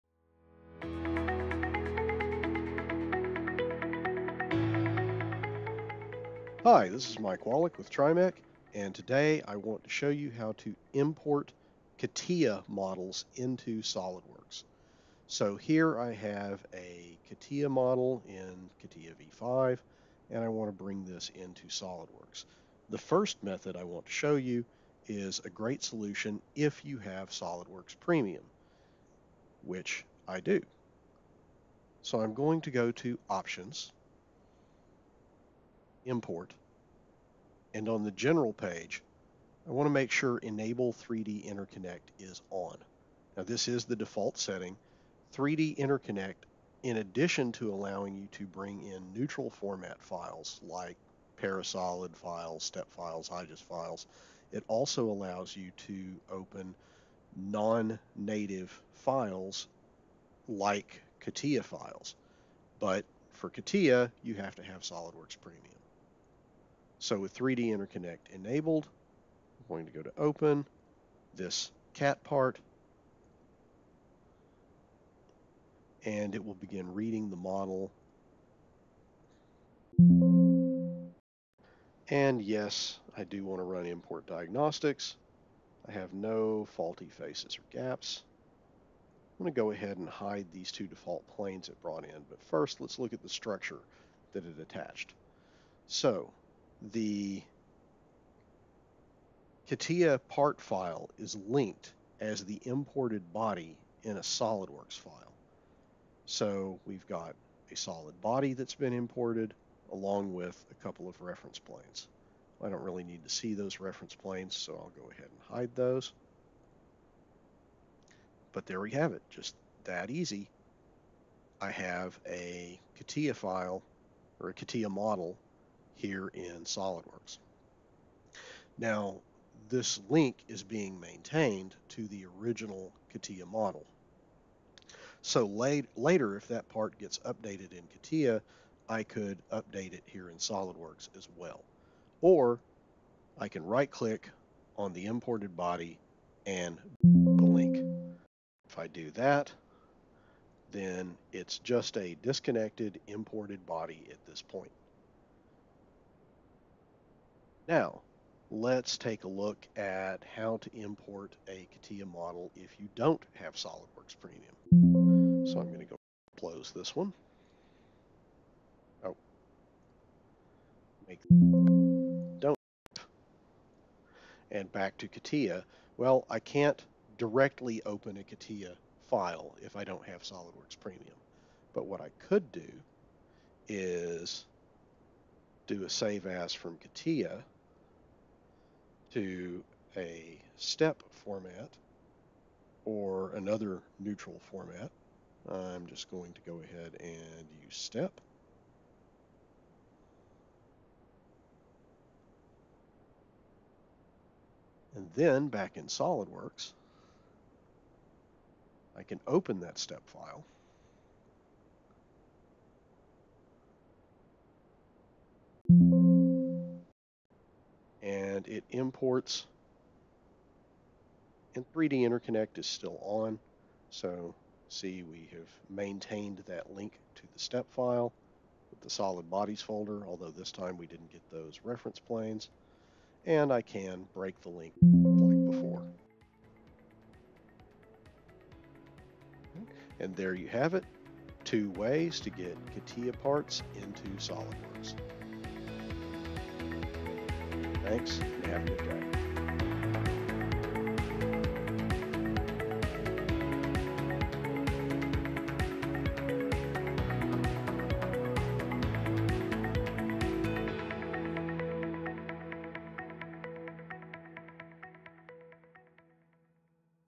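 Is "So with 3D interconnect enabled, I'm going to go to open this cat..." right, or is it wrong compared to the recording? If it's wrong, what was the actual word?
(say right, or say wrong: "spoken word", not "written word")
right.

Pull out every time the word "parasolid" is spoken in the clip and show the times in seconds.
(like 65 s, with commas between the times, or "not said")
51 s.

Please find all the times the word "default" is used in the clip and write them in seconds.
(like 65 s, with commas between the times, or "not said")
43 s, 90 s.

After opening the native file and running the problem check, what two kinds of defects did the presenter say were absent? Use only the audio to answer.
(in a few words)
faulty faces or gaps.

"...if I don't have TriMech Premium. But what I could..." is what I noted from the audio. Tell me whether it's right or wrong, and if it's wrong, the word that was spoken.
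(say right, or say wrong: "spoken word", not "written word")
wrong: "SOLIDWORKS", not "TriMech".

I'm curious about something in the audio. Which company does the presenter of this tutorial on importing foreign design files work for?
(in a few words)
TriMech.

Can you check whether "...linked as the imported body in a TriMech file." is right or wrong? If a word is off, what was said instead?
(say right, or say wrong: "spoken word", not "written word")
wrong: "SOLIDWORKS", not "TriMech".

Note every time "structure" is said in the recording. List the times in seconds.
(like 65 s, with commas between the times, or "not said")
93 s.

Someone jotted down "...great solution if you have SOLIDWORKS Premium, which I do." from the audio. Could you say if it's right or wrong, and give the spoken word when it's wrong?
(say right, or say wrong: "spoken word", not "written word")
right.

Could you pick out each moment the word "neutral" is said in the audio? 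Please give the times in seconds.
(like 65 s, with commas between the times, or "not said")
49 s, 193 s.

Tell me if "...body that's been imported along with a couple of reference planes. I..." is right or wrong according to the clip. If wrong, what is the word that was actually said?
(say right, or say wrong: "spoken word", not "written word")
right.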